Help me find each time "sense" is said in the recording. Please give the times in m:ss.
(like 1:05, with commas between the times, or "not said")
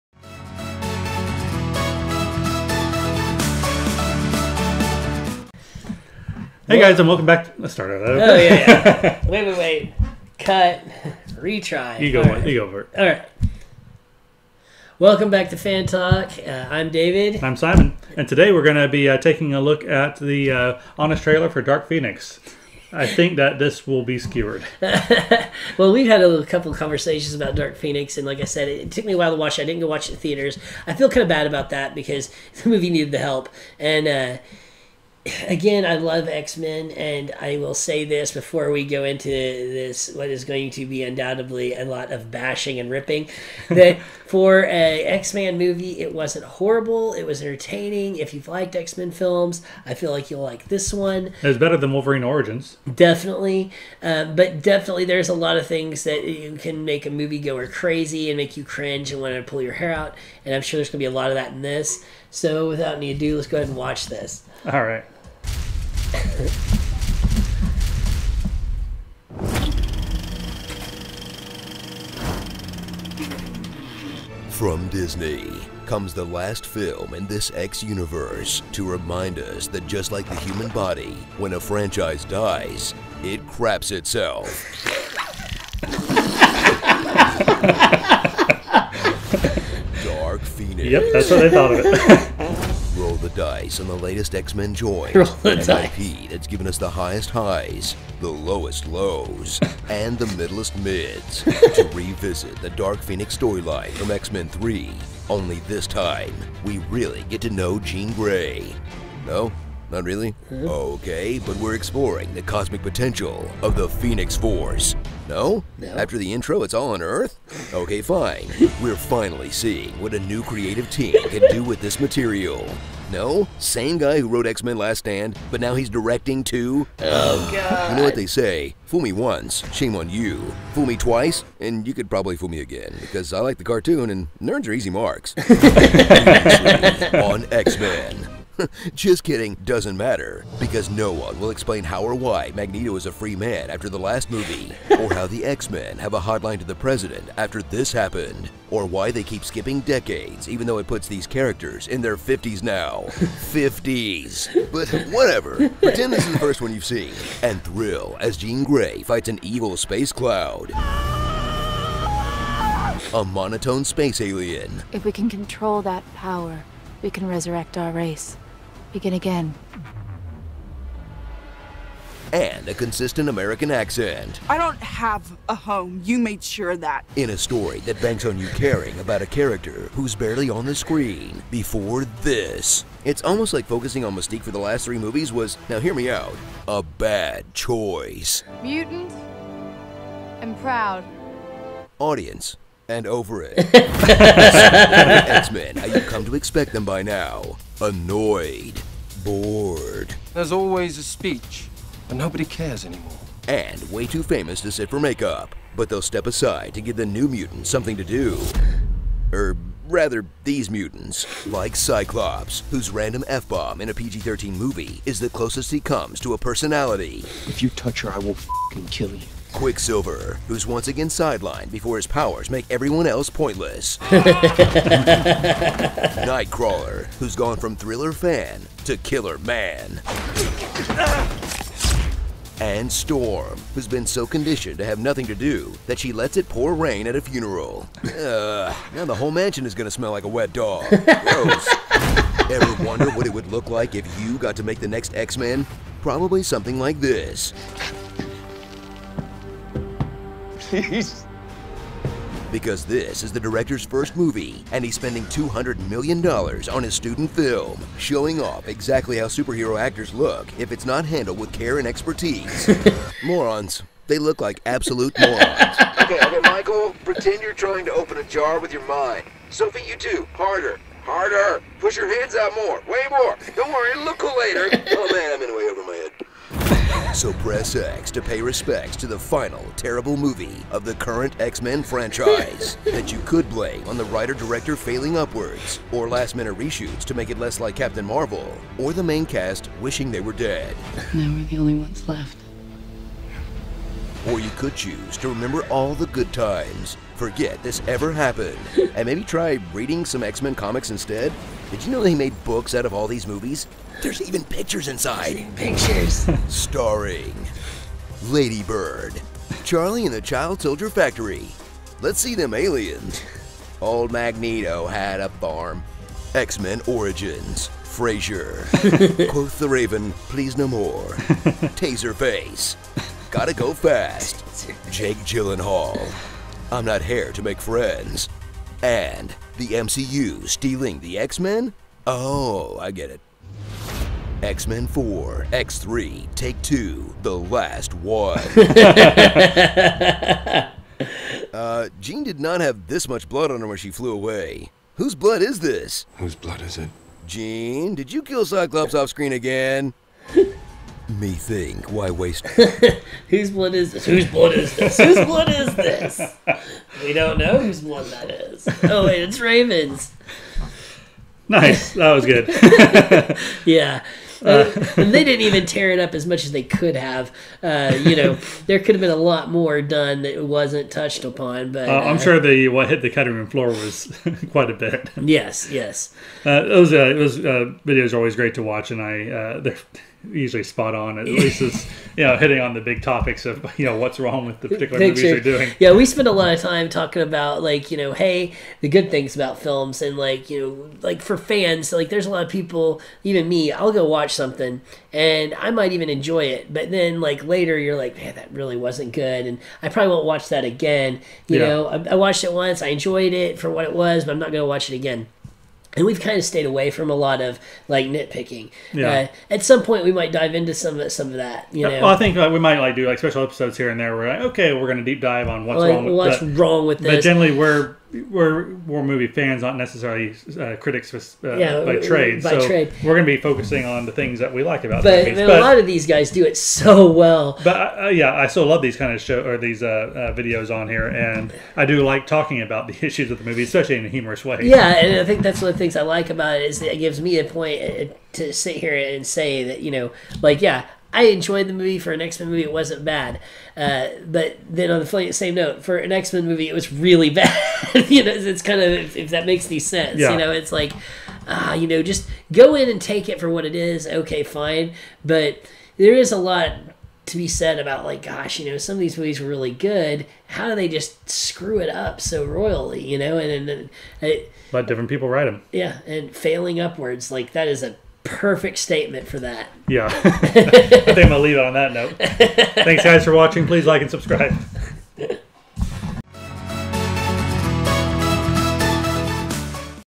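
7:29.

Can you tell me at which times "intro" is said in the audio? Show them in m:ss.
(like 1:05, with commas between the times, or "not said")
1:56.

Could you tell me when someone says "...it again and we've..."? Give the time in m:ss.
6:44.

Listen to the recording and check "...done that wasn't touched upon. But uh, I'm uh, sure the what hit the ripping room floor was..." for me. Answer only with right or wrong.
wrong.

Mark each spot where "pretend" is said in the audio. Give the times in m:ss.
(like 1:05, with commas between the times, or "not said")
2:35, 4:27.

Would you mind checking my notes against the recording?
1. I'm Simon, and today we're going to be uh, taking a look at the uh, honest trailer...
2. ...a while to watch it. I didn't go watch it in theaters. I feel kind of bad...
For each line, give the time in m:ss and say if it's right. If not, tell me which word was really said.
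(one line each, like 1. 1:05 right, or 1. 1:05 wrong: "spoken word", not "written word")
1. 0:17 right
2. 0:29 right.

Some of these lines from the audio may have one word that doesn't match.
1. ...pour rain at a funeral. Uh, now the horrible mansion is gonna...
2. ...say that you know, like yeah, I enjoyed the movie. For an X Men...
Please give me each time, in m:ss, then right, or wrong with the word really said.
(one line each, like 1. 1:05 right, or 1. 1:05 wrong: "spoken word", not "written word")
1. 3:56 wrong: "whole", not "horrible"
2. 7:19 right.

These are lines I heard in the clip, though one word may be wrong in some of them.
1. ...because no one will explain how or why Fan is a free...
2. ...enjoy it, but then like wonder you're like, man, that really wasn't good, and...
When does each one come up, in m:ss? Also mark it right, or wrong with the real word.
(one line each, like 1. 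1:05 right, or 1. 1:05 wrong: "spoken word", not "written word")
1. 2:20 wrong: "Magneto", not "Fan"
2. 6:36 wrong: "later", not "wonder".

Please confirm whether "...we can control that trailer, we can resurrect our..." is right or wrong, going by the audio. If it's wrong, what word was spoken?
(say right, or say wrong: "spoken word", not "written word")
wrong: "power", not "trailer".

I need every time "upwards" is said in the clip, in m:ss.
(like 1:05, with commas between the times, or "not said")
4:45, 7:46.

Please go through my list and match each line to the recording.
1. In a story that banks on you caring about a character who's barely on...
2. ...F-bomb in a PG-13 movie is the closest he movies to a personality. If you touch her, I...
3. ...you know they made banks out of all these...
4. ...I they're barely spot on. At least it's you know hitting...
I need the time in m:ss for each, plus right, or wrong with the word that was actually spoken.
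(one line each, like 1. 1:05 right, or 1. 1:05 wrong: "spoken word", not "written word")
1. 2:57 right
2. 3:33 wrong: "comes", not "movies"
3. 5:01 wrong: "books", not "banks"
4. 6:18 wrong: "usually", not "barely".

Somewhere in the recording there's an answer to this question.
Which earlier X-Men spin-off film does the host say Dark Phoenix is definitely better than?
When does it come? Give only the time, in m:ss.
0:51.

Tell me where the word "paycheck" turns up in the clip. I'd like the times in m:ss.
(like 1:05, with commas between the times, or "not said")
not said.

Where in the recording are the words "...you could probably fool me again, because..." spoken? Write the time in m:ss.
2:11.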